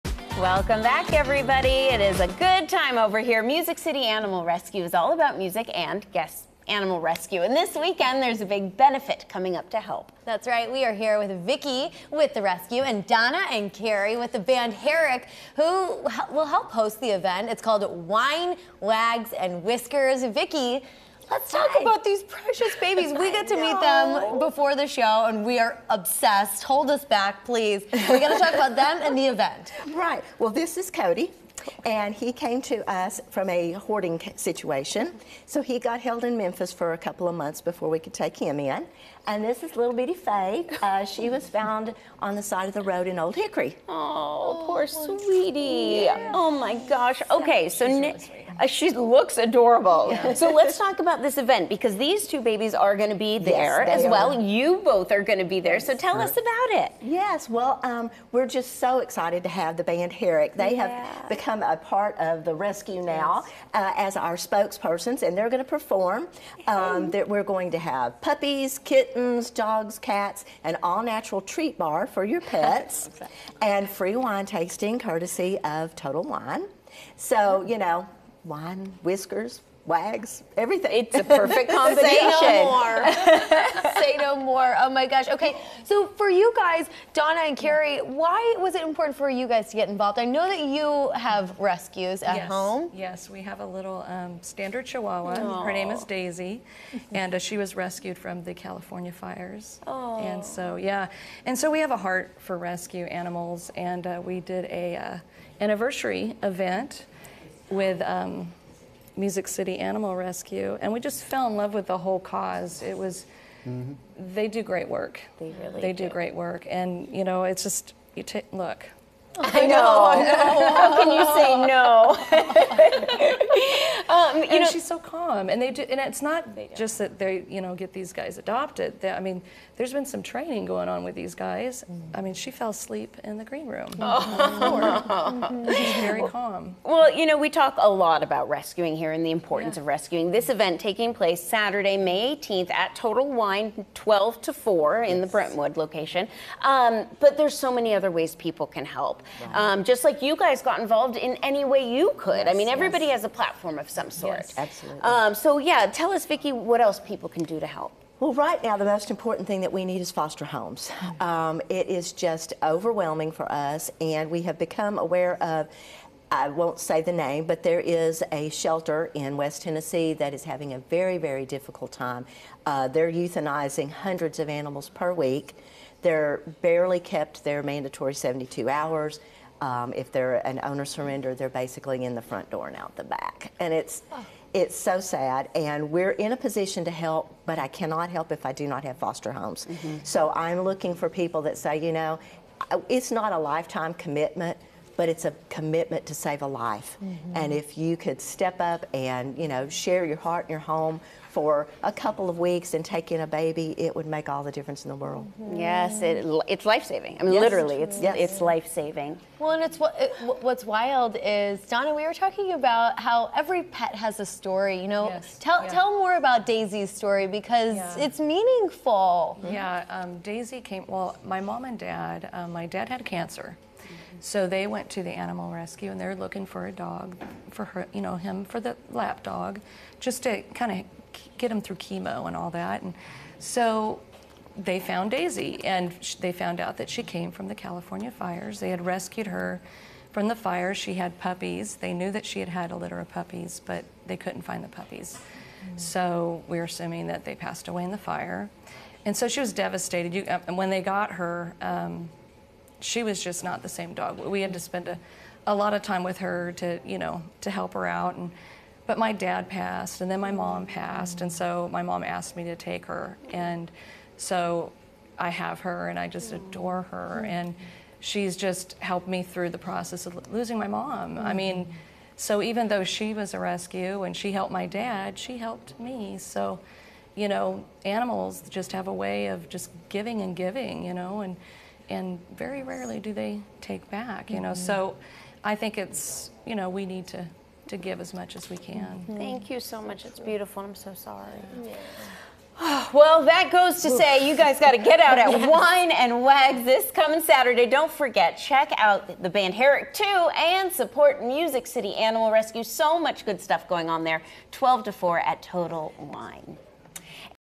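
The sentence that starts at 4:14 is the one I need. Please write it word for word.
We had to spend a, a lot of time with her to, you know, to help her out.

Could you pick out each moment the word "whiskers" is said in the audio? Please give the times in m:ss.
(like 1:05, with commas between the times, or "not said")
0:19, 1:19.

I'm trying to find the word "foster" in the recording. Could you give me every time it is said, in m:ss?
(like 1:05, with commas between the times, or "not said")
2:40, 3:08.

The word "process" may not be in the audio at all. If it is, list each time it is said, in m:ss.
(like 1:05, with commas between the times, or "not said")
4:29.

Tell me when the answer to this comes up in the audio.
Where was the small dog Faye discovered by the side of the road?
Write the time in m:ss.
0:43.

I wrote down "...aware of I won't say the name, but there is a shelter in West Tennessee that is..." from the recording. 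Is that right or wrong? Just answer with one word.
right.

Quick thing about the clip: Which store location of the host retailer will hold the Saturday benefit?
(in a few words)
Brentwood.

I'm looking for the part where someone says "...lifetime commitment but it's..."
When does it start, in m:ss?
3:13.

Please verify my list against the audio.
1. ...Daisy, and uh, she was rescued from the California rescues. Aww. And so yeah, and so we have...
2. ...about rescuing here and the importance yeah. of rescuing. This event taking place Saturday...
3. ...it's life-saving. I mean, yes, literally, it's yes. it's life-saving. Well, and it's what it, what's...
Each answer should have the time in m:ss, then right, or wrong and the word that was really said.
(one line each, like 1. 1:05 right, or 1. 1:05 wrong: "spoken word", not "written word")
1. 1:36 wrong: "fires", not "rescues"
2. 2:18 right
3. 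3:26 right.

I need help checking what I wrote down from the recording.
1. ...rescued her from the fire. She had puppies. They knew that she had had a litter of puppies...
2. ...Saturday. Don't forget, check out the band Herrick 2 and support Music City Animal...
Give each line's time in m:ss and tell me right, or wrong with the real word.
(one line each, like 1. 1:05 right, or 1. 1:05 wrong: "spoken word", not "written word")
1. 3:58 right
2. 4:57 right.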